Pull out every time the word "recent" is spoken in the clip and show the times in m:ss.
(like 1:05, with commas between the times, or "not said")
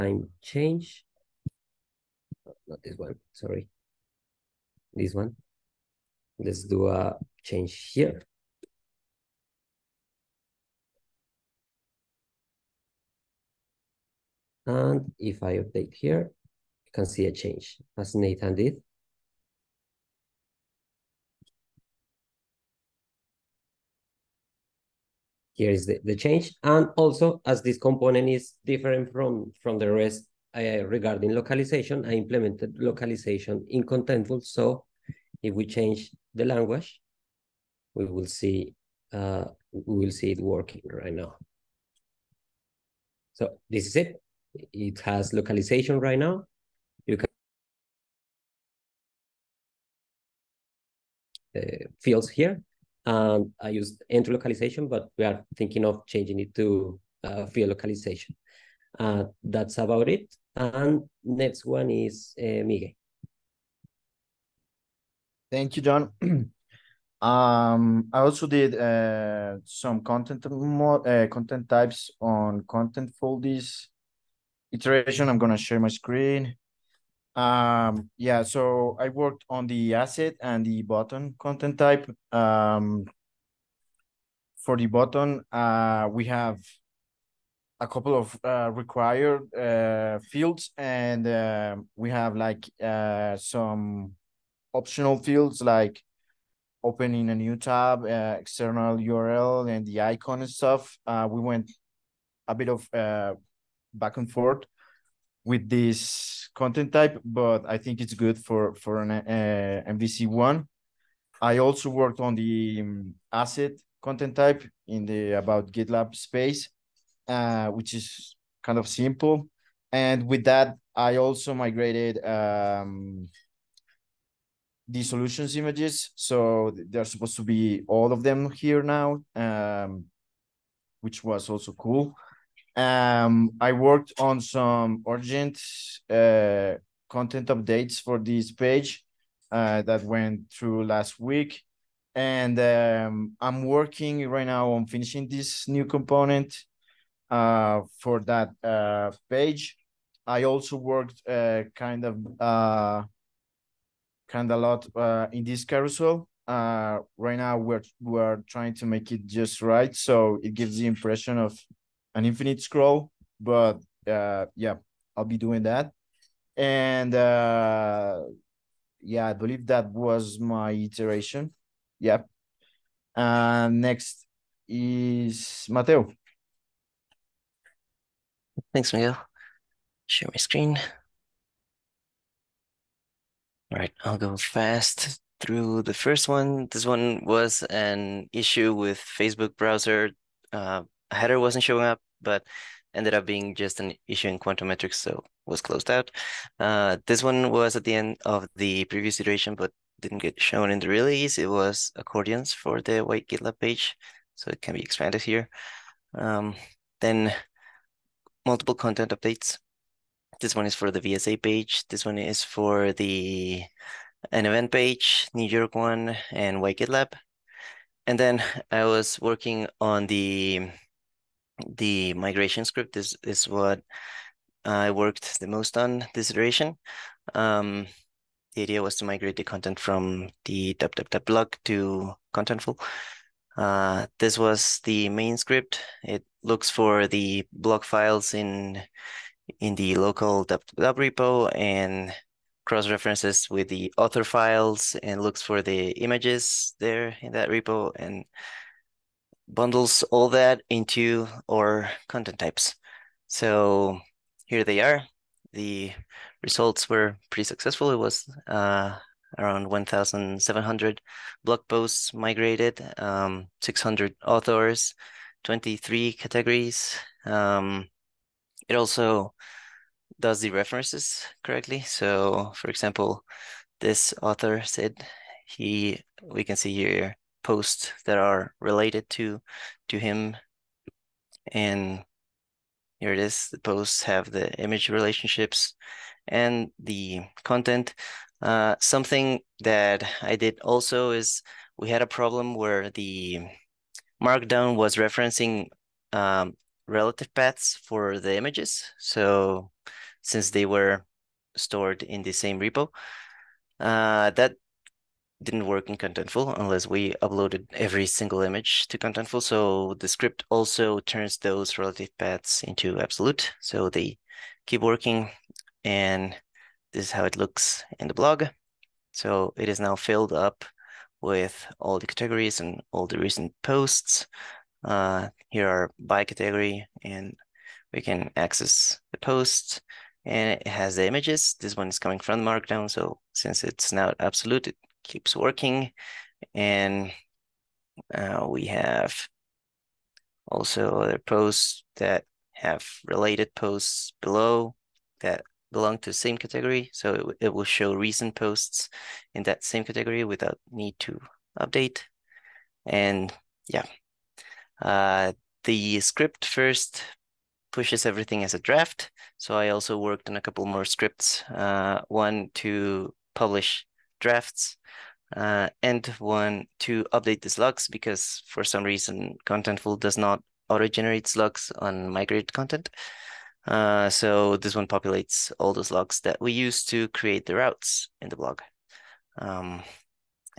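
5:23, 5:47.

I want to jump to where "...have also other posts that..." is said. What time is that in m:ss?
5:38.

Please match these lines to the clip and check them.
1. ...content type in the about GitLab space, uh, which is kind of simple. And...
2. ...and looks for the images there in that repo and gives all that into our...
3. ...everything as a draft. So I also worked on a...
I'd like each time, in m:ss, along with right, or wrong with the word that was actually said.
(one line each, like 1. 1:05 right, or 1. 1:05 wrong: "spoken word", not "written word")
1. 1:54 right
2. 4:05 wrong: "bundles", not "gives"
3. 5:58 right.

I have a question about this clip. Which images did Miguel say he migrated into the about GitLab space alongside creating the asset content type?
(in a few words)
Solutions images.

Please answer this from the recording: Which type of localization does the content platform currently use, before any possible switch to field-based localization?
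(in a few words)
Entry localization.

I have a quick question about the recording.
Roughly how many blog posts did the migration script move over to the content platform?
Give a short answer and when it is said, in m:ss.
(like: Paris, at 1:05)
1,700, at 4:19.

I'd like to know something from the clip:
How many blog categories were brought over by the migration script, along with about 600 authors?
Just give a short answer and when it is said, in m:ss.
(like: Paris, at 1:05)
23, at 4:25.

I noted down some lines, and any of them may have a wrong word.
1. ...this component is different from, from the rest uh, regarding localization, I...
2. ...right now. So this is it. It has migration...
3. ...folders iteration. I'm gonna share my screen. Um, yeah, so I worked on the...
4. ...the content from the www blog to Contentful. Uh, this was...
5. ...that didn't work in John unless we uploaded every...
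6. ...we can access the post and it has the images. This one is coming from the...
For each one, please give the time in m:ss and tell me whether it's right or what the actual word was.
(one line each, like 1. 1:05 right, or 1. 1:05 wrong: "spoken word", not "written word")
1. 0:27 right
2. 0:40 wrong: "localization", not "migration"
3. 1:13 right
4. 3:49 right
5. 5:04 wrong: "Contentful", not "John"
6. 5:27 right.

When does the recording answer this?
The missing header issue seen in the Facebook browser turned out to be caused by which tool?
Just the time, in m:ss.
3:14.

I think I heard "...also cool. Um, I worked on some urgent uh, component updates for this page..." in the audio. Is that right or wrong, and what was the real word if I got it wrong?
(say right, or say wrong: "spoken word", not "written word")
wrong: "content", not "component".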